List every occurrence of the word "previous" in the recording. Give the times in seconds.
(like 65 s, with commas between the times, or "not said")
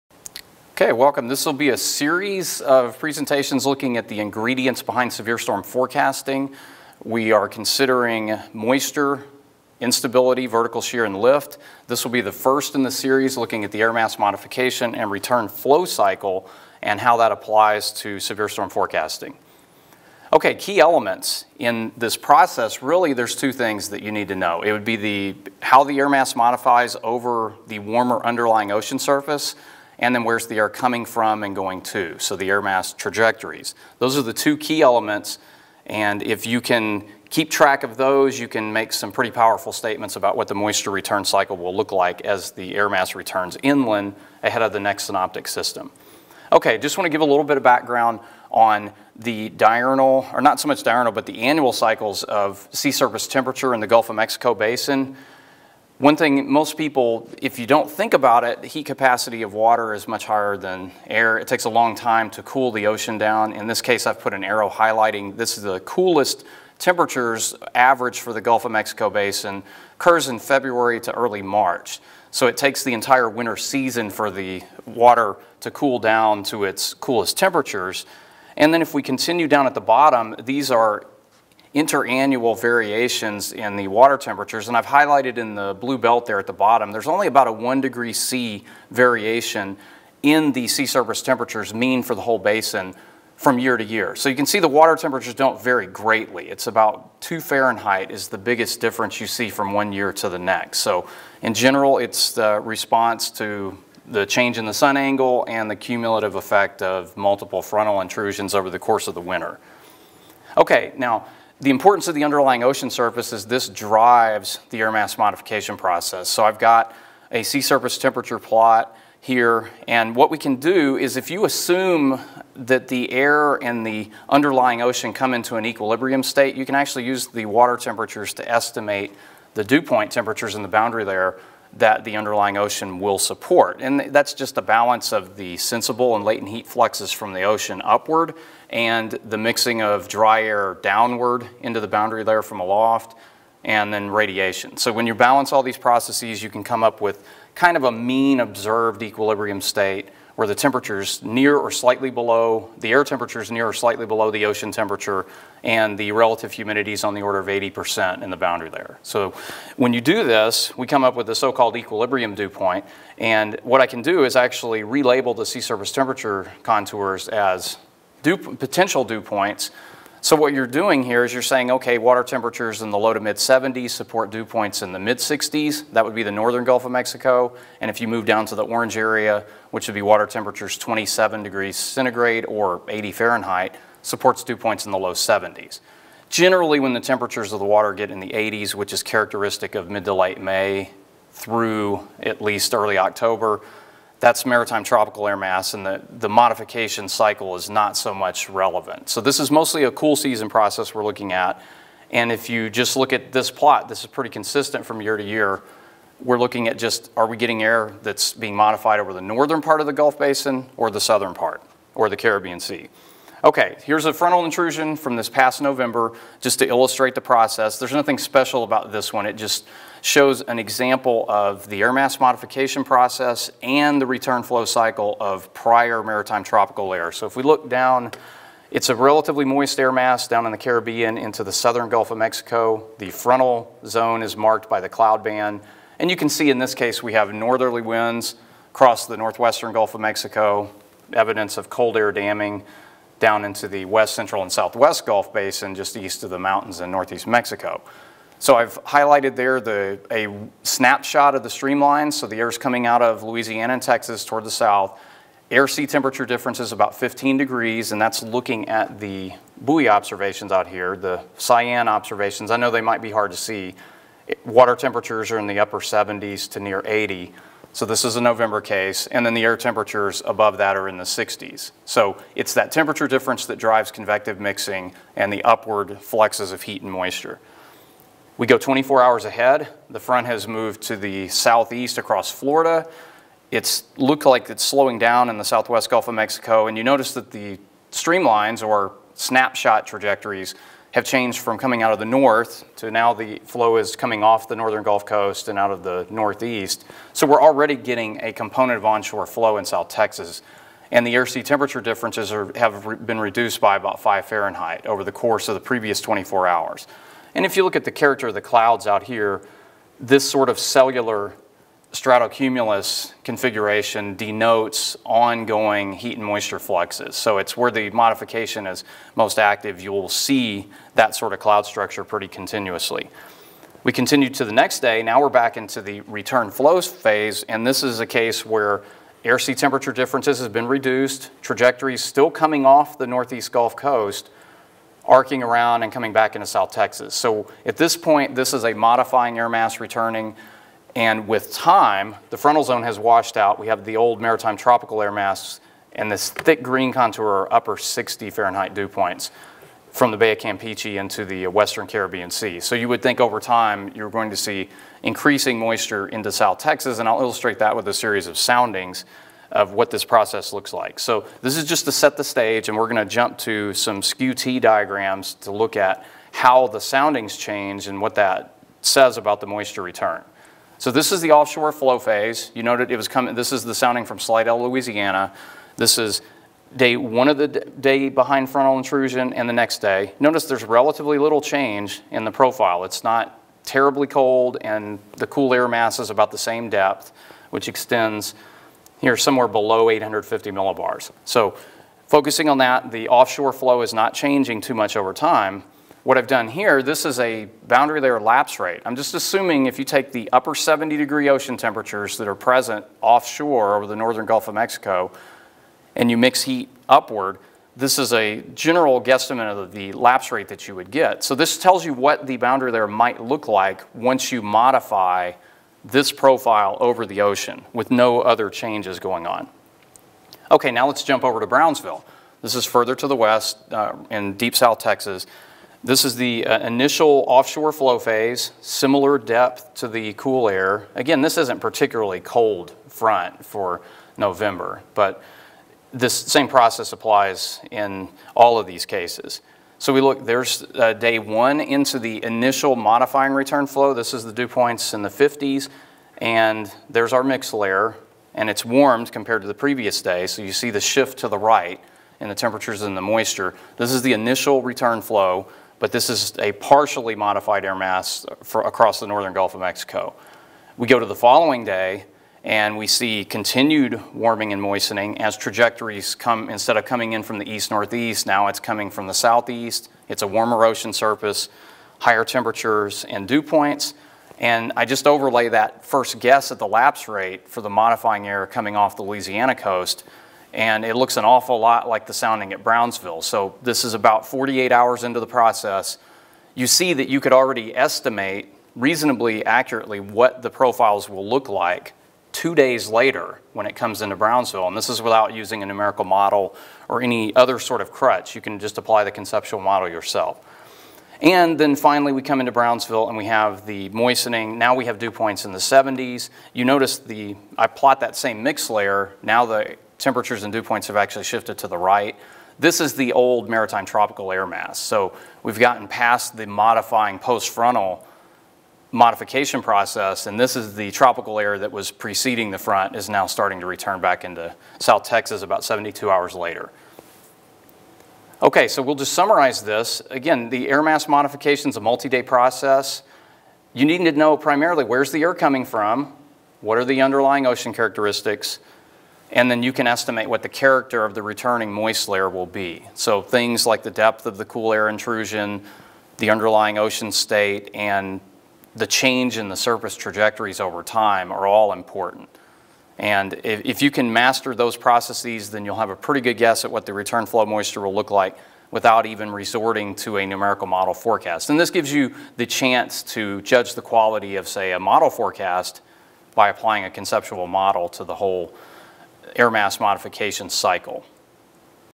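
305 s, 449 s.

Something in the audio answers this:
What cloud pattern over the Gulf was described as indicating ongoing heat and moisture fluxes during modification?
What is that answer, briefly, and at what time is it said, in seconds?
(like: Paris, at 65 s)
cellular stratocumulus, at 310 s.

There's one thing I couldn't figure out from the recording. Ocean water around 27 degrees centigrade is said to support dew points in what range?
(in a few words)
low 70s.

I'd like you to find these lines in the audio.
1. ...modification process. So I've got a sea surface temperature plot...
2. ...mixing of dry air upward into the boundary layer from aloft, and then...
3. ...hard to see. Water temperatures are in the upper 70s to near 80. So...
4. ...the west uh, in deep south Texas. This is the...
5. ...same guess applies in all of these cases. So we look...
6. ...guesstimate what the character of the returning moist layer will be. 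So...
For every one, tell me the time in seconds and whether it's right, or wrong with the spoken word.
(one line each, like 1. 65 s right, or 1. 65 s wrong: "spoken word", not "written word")
1. 115 s right
2. 139 s wrong: "downward", not "upward"
3. 263 s right
4. 423 s right
5. 436 s wrong: "process", not "guess"
6. 539 s wrong: "estimate", not "guesstimate".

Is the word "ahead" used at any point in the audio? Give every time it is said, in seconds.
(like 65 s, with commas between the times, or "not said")
44 s, 279 s.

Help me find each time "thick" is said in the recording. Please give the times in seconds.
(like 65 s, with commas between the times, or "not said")
346 s.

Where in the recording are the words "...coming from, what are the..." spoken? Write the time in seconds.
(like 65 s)
535 s.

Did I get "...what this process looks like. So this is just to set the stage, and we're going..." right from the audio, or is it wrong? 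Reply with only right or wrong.
right.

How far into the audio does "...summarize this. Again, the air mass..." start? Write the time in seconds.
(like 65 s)
529 s.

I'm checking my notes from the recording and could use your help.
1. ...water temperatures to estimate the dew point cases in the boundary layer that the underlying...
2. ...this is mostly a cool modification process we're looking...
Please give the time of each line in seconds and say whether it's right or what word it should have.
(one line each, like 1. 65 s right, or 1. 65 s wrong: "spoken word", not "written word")
1. 127 s wrong: "temperatures", not "cases"
2. 199 s wrong: "season", not "modification".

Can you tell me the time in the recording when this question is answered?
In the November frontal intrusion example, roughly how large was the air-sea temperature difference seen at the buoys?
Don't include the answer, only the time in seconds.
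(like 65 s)
256 s.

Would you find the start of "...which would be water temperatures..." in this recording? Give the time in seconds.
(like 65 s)
179 s.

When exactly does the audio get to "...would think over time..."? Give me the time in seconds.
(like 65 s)
352 s.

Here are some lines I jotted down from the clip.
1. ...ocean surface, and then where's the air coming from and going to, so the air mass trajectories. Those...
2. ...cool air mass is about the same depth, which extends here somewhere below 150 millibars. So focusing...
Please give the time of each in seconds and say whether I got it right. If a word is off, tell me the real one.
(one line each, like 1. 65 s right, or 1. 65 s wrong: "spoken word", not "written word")
1. 28 s right
2. 385 s wrong: "850", not "150".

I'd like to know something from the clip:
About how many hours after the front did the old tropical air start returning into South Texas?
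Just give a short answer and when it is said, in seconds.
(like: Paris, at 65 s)
72, at 525 s.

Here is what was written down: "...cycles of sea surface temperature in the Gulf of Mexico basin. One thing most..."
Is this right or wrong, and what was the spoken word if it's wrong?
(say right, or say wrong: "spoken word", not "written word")
right.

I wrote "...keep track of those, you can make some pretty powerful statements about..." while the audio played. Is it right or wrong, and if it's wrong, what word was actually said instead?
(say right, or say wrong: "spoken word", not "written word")
right.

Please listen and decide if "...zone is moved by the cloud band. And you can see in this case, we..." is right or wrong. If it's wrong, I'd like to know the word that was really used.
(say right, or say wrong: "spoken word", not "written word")
wrong: "marked", not "moved".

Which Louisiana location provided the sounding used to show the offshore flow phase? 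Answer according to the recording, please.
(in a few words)
Slidell.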